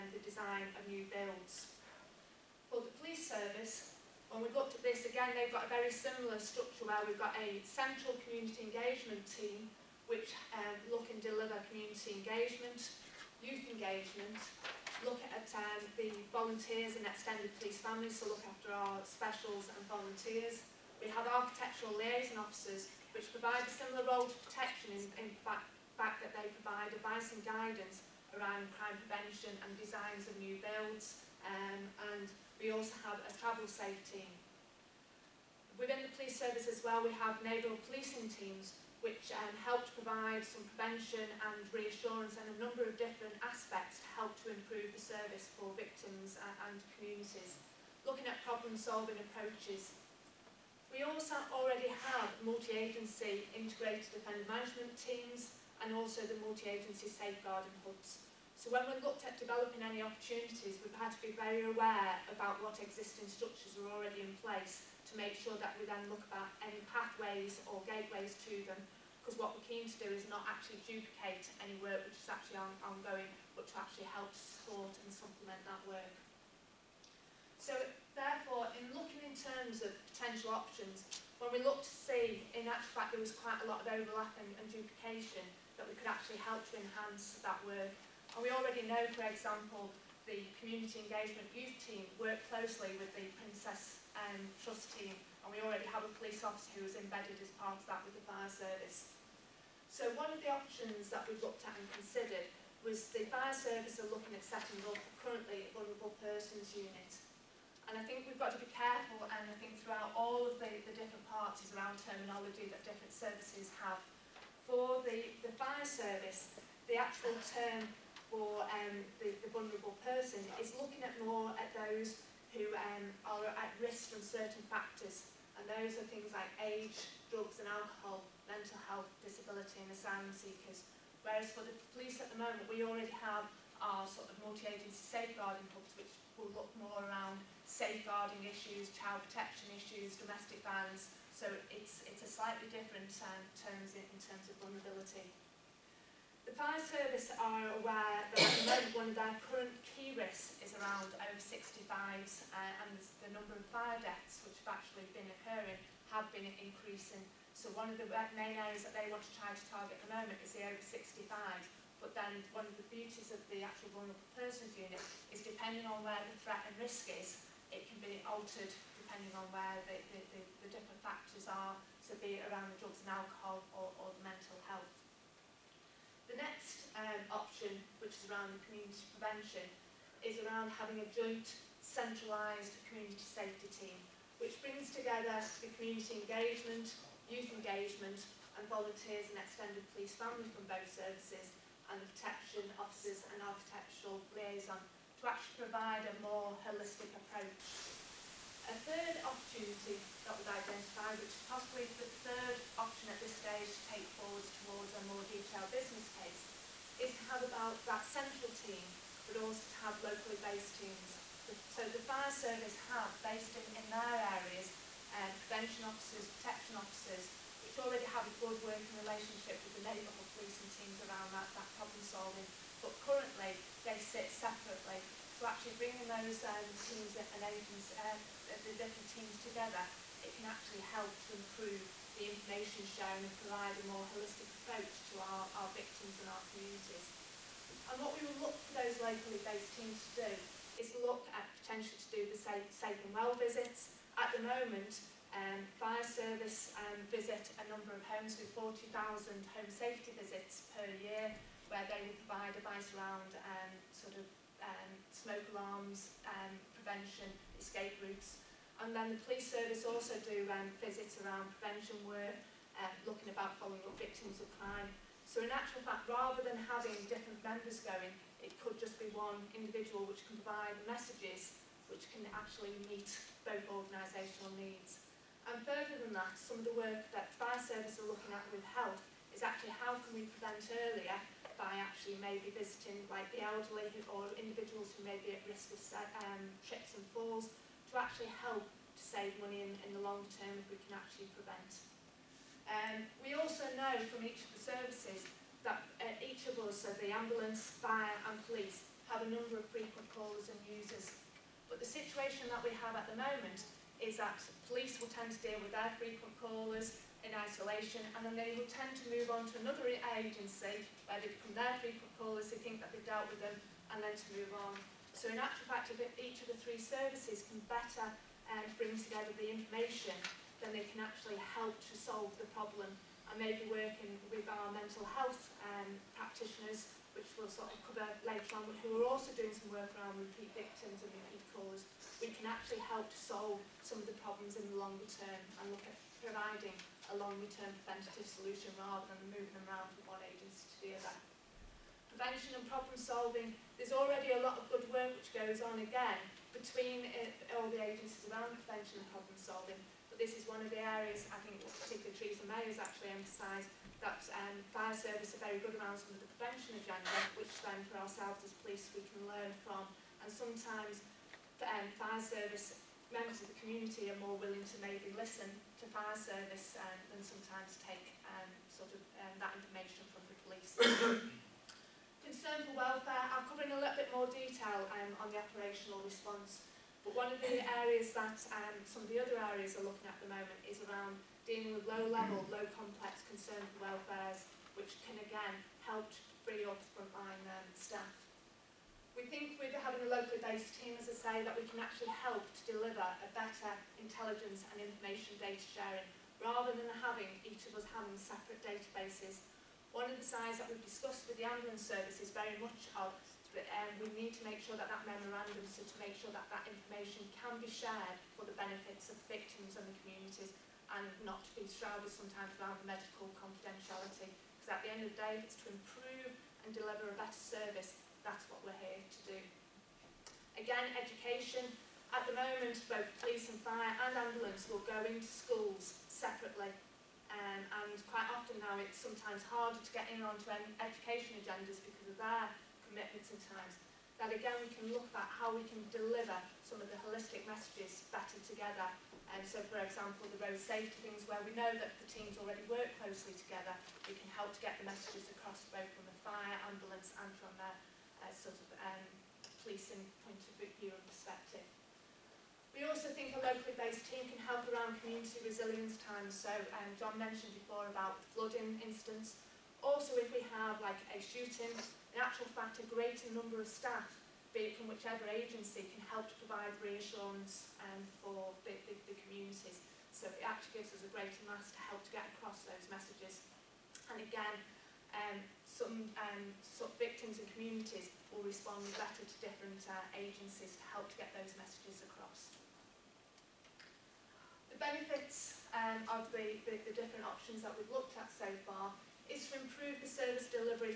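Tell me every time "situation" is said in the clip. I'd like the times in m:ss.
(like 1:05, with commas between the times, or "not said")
5:01.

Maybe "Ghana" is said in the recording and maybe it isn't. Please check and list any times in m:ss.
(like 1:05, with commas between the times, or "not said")
not said.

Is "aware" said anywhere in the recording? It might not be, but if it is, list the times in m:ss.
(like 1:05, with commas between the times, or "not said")
1:01, 2:27.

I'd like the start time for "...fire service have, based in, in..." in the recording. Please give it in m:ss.
3:32.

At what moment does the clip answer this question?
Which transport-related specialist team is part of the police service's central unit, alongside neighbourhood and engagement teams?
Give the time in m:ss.
0:33.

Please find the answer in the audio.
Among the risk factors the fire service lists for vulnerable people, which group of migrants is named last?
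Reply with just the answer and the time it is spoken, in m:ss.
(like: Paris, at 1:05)
Asylum seekers, at 2:09.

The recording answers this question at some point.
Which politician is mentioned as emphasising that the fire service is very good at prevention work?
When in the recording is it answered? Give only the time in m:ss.
5:52.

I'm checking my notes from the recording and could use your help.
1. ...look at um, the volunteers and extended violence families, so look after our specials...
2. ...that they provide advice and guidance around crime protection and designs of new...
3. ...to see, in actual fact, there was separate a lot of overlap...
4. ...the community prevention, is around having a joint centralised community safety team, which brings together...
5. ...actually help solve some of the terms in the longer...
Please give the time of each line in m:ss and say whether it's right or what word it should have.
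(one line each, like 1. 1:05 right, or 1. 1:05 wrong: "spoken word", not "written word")
1. 0:15 wrong: "police", not "violence"
2. 0:26 wrong: "prevention", not "protection"
3. 1:21 wrong: "quite", not "separate"
4. 2:58 right
5. 5:32 wrong: "problems", not "terms".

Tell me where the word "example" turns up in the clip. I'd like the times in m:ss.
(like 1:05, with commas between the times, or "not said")
1:29, 7:19.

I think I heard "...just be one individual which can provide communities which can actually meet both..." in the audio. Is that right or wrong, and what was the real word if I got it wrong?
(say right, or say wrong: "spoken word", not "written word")
wrong: "messages", not "communities".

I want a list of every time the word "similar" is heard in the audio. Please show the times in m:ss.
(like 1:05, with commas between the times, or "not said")
0:05, 0:23.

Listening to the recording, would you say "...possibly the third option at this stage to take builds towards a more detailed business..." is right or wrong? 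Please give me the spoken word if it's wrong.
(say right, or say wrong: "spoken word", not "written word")
wrong: "forwards", not "builds".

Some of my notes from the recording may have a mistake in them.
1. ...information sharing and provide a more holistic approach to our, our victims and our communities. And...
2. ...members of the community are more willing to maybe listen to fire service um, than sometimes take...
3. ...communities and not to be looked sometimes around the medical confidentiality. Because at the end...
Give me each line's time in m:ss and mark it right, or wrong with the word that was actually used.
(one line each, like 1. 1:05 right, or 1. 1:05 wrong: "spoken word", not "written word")
1. 3:52 right
2. 6:03 right
3. 6:50 wrong: "shrouded", not "looked".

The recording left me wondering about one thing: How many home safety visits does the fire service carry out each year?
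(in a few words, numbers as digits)
40,000.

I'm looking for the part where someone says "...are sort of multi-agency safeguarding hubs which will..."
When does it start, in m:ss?
2:13.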